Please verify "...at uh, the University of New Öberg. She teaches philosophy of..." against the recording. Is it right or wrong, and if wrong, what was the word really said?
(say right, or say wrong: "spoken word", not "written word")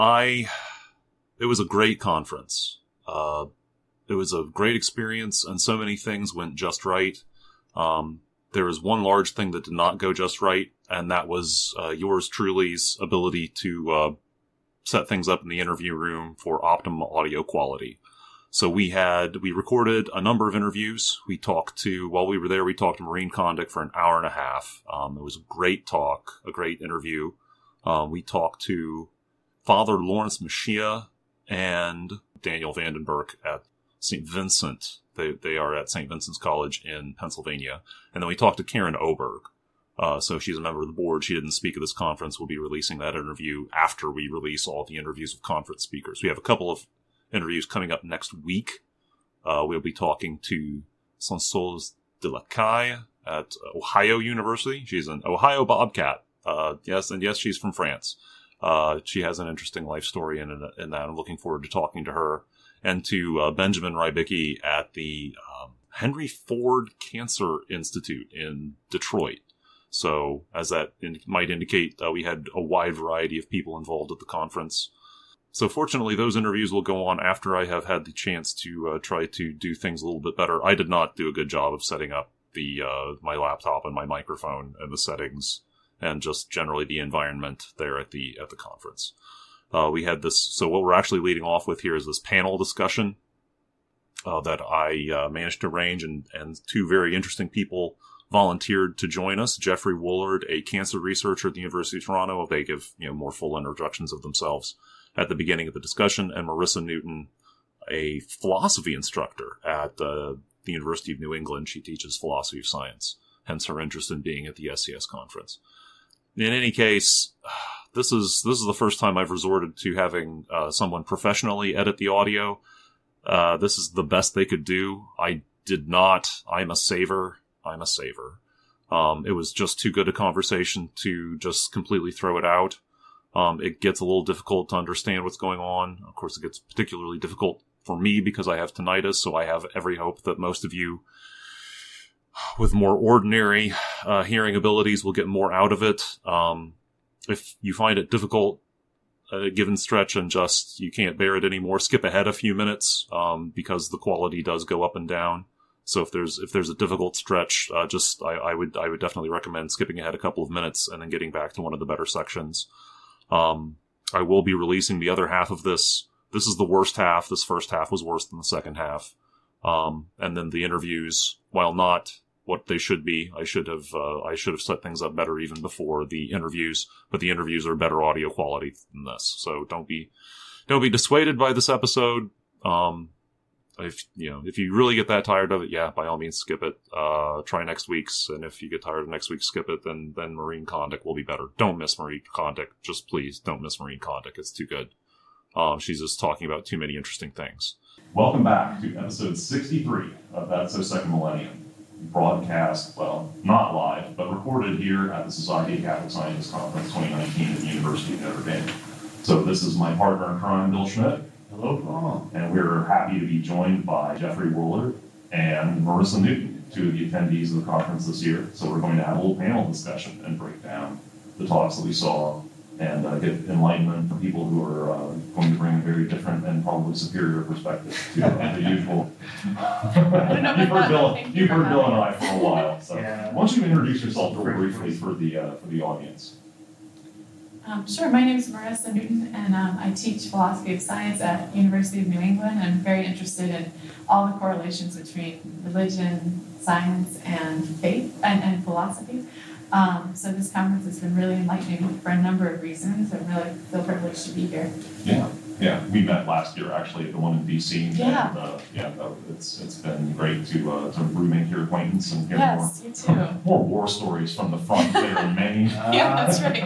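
wrong: "England", not "Öberg".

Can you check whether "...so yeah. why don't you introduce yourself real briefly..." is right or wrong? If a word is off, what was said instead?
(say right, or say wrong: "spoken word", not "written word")
right.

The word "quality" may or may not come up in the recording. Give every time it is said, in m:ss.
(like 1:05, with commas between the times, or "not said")
0:17, 2:33, 2:58.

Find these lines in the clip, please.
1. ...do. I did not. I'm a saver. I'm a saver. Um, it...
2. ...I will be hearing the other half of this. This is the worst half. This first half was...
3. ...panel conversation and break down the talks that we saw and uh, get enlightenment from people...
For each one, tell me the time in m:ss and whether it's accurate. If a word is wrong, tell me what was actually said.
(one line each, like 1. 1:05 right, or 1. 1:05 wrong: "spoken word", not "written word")
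1. 2:04 right
2. 2:44 wrong: "releasing", not "hearing"
3. 3:39 wrong: "discussion", not "conversation".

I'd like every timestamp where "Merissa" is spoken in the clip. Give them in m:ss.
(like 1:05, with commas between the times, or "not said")
1:46, 3:35, 3:58.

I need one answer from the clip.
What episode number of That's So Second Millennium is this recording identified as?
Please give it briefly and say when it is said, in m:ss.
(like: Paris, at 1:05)
63, at 3:19.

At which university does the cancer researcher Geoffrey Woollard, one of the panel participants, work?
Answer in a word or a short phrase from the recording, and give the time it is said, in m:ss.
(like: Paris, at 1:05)
University of Toronto, at 1:41.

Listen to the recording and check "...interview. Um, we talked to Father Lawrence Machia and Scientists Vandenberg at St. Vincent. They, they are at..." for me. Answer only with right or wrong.
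wrong.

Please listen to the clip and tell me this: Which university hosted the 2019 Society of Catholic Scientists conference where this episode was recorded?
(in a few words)
University of Notre Dame.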